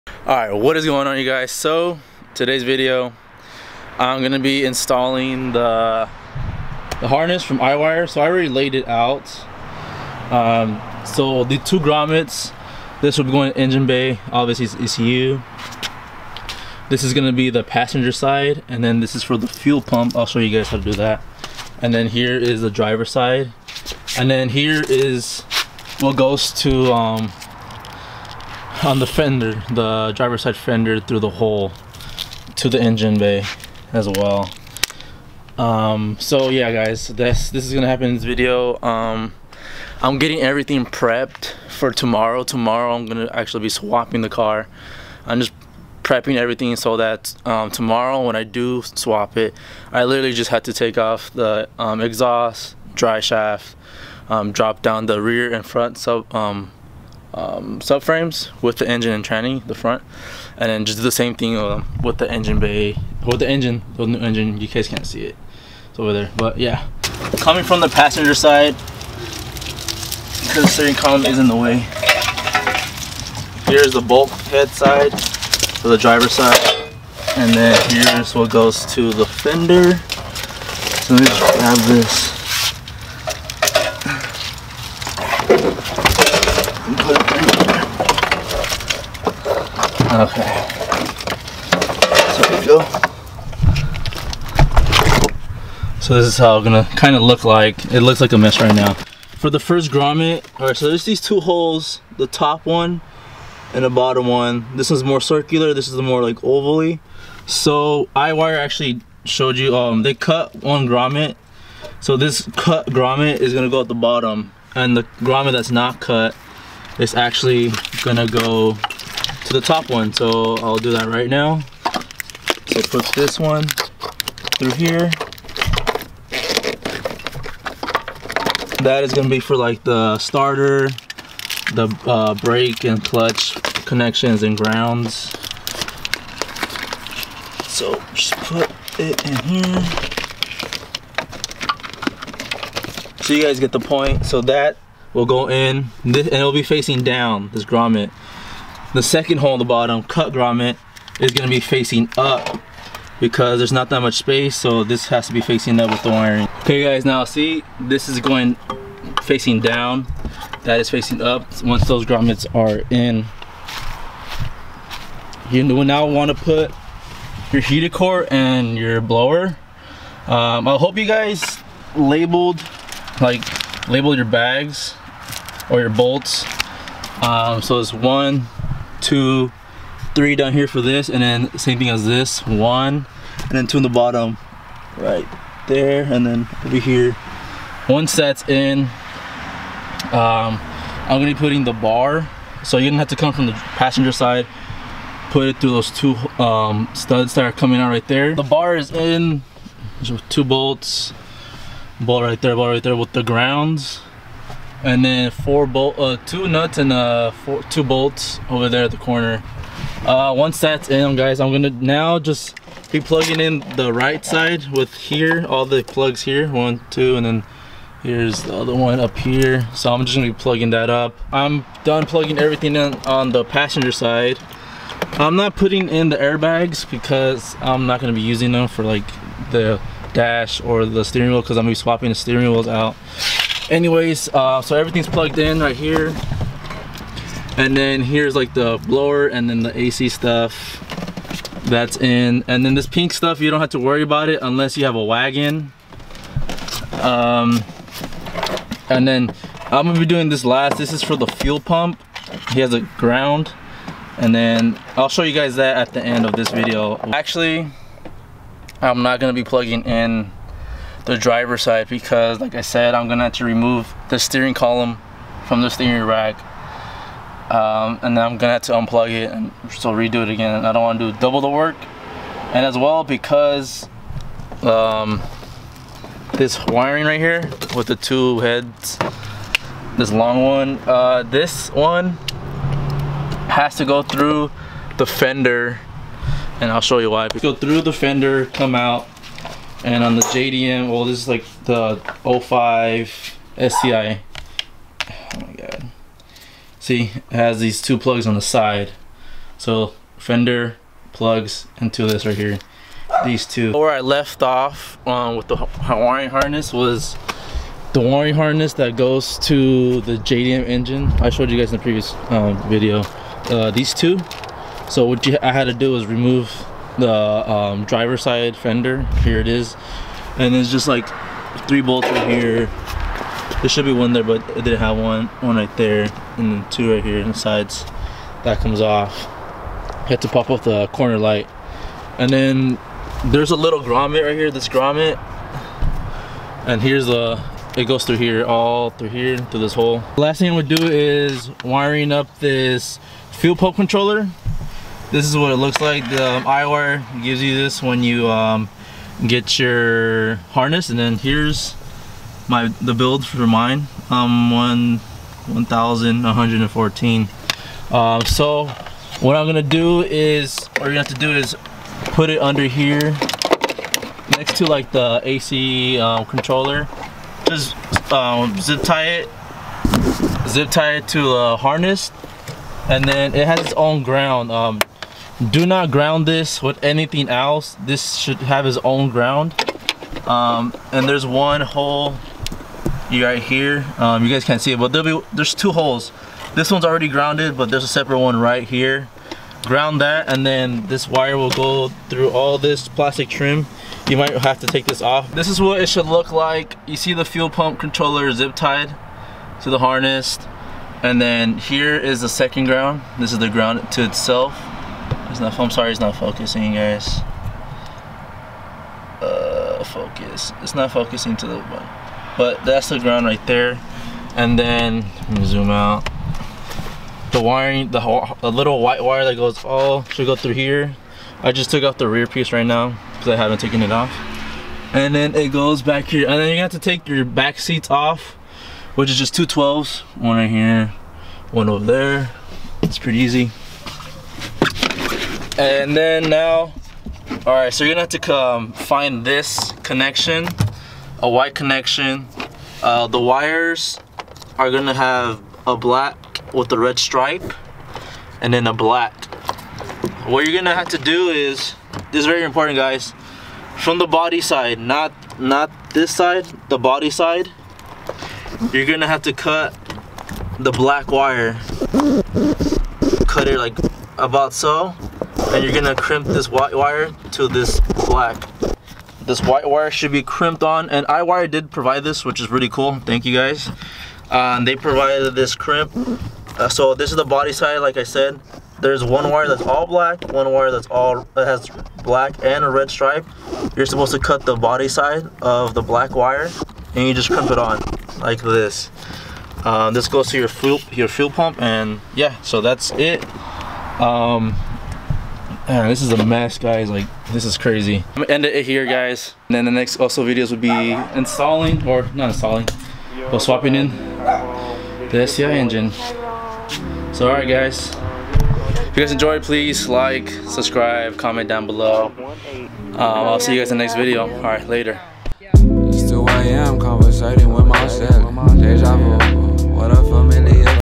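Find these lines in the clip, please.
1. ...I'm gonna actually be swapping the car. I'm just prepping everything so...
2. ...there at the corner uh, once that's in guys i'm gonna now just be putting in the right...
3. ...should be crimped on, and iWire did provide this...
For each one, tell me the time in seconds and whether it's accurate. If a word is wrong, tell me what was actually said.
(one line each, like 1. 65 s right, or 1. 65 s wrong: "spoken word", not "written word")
1. 42 s right
2. 208 s wrong: "plugging", not "putting"
3. 469 s right.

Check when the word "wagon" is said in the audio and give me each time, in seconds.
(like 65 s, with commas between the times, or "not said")
245 s.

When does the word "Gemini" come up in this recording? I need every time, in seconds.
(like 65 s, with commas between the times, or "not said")
not said.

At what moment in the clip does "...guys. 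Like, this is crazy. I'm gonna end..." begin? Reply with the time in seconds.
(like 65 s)
496 s.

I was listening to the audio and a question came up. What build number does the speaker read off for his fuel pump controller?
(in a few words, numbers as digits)
1114.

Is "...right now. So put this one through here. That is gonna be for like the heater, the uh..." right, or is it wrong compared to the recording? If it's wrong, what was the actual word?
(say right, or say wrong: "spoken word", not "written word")
wrong: "starter", not "heater".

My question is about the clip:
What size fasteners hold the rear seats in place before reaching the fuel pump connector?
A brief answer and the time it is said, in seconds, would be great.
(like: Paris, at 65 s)
12s, at 429 s.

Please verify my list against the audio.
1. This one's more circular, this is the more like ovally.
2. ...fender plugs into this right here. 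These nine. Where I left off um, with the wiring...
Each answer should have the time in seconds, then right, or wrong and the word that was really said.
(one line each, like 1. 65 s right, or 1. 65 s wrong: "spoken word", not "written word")
1. 104 s right
2. 300 s wrong: "two", not "nine".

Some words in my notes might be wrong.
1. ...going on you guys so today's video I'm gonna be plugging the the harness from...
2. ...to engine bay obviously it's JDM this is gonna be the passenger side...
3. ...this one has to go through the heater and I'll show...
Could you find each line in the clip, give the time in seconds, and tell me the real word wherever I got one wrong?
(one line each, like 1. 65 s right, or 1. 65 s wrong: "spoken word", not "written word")
1. 0 s wrong: "installing", not "plugging"
2. 13 s wrong: "ECU", not "JDM"
3. 281 s wrong: "fender", not "heater".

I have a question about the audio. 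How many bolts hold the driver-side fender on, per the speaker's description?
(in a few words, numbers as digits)
3.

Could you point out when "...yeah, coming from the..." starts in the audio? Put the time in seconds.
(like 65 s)
66 s.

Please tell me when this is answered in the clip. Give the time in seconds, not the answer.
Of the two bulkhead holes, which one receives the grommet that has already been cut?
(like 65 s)
112 s.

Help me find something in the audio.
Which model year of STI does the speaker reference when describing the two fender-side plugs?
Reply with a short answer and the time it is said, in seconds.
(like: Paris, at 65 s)
2005, at 292 s.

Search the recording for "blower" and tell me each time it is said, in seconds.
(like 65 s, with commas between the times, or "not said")
169 s, 238 s.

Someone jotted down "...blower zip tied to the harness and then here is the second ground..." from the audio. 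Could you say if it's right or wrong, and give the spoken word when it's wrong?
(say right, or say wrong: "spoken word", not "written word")
wrong: "controller", not "blower".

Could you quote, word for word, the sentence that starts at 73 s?
Here's the bulkhead side, for the driver's side, and then here's what goes to the fender.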